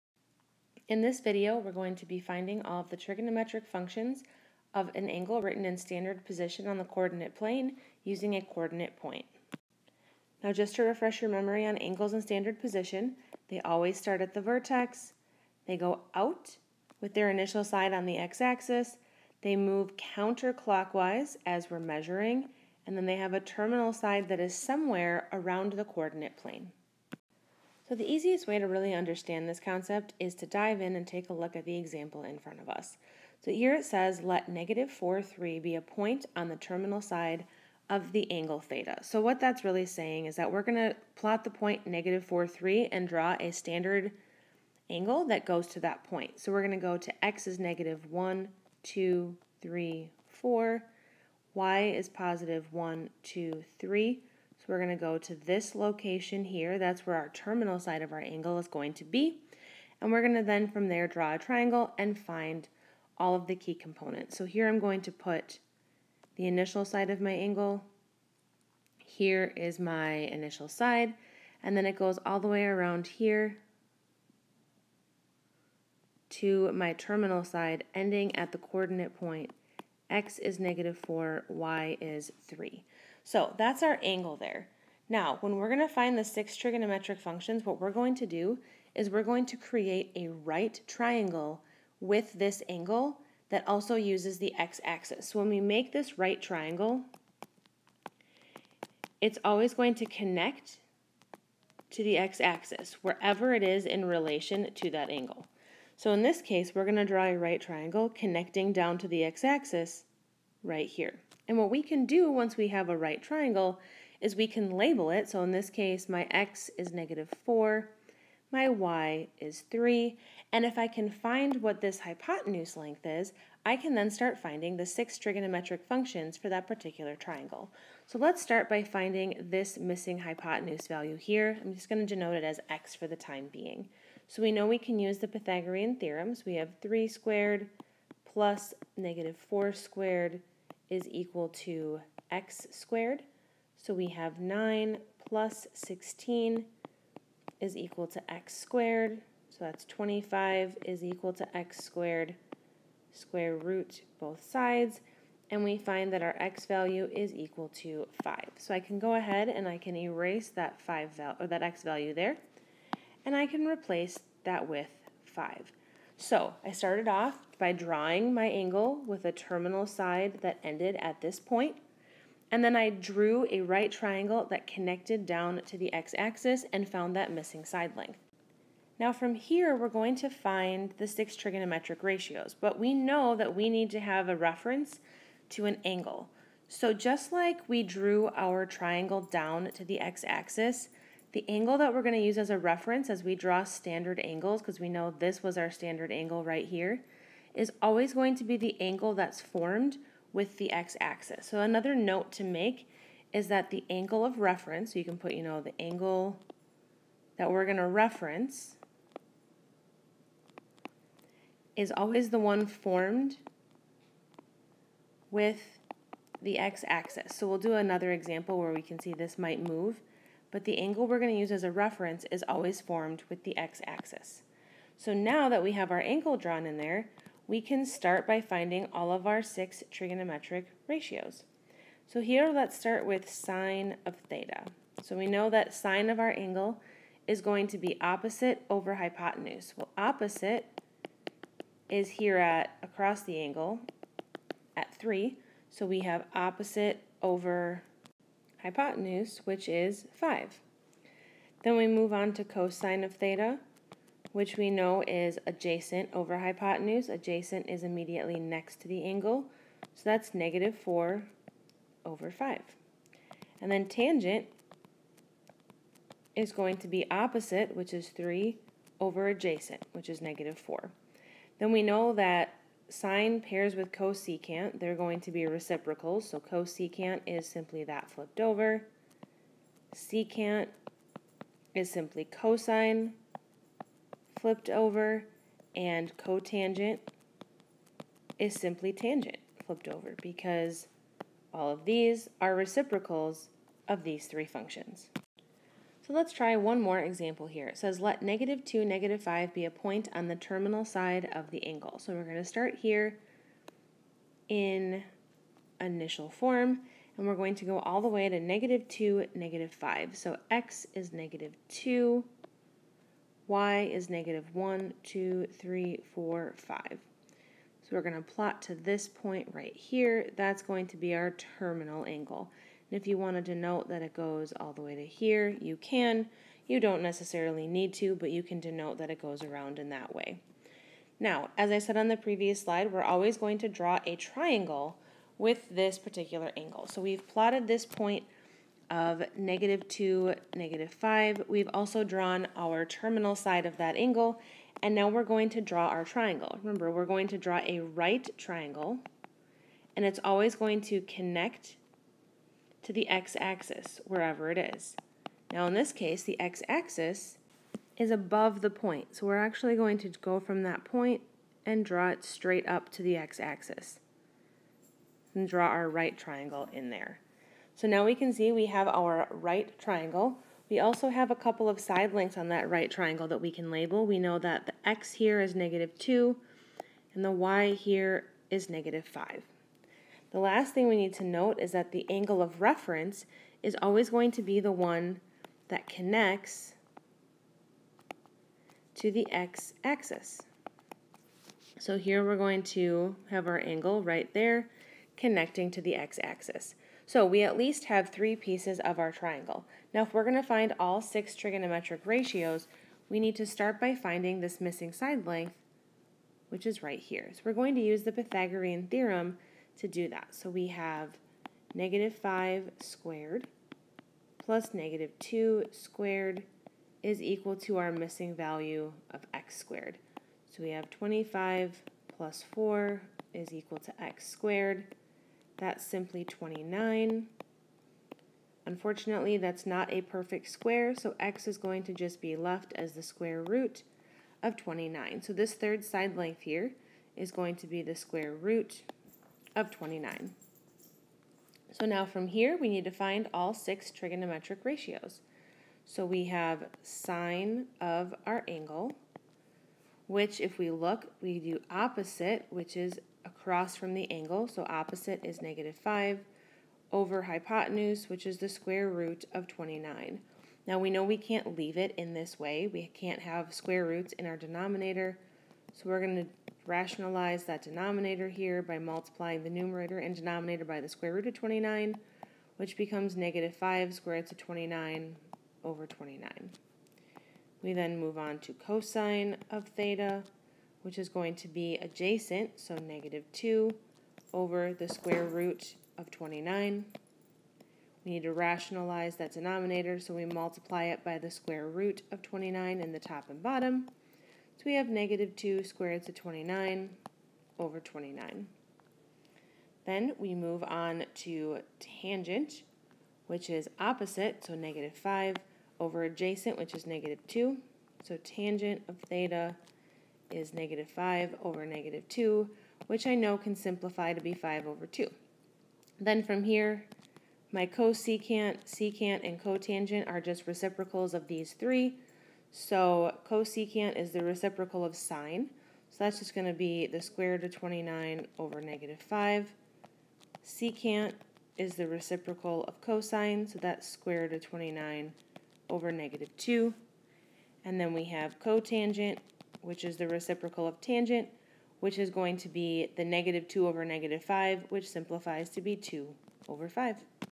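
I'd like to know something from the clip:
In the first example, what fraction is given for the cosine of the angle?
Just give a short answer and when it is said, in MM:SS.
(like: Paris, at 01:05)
-4/5, at 04:20.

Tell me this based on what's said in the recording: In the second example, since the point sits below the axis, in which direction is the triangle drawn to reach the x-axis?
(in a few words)
straight up.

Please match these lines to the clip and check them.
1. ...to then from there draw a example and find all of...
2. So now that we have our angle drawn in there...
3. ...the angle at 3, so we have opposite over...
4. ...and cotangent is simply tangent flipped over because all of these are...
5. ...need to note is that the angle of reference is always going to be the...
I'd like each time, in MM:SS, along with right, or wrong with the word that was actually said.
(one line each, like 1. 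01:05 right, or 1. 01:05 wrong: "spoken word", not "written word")
1. 01:00 wrong: "triangle", not "example"
2. 03:44 right
3. 04:03 right
4. 04:45 right
5. 06:20 right.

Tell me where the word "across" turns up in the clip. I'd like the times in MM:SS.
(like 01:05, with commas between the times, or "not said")
04:02, 07:33.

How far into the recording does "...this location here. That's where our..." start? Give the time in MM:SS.
00:55.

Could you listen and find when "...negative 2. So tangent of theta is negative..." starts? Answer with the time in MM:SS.
08:26.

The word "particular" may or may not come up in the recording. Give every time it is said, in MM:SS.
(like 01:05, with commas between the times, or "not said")
02:06, 05:35.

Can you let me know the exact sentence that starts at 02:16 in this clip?
We have 3 squared plus negative 4 squared is equal to x squared.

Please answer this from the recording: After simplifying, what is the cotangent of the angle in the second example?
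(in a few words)
2/5.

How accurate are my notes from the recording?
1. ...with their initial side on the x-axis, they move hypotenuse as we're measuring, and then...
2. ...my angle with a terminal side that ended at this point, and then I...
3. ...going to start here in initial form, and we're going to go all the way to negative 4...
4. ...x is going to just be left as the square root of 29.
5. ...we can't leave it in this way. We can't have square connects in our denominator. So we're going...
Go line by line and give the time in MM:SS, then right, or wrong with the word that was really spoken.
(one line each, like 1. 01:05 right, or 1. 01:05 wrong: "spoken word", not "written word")
1. 00:16 wrong: "counterclockwise", not "hypotenuse"
2. 02:48 right
3. 05:02 wrong: "2", not "4"
4. 07:11 right
5. 07:41 wrong: "roots", not "connects".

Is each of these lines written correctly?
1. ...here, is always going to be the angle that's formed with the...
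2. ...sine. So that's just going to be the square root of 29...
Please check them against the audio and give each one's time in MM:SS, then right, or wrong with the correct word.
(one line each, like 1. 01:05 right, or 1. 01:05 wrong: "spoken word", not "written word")
1. 03:16 right
2. 08:44 right.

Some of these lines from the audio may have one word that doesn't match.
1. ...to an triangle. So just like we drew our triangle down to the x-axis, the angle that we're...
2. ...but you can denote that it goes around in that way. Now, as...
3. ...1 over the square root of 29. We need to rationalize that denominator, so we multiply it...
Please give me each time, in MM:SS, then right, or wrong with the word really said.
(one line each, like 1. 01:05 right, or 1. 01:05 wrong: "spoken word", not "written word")
1. 03:05 wrong: "angle", not "triangle"
2. 05:28 right
3. 08:03 wrong: "2", not "1".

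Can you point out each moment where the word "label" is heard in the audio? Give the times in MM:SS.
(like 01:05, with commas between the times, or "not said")
01:54, 06:13.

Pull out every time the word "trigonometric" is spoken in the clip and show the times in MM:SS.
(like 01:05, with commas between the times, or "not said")
00:02, 01:26, 02:05, 03:01, 03:49, 06:41, 07:23.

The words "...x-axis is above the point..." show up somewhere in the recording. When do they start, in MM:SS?
05:56.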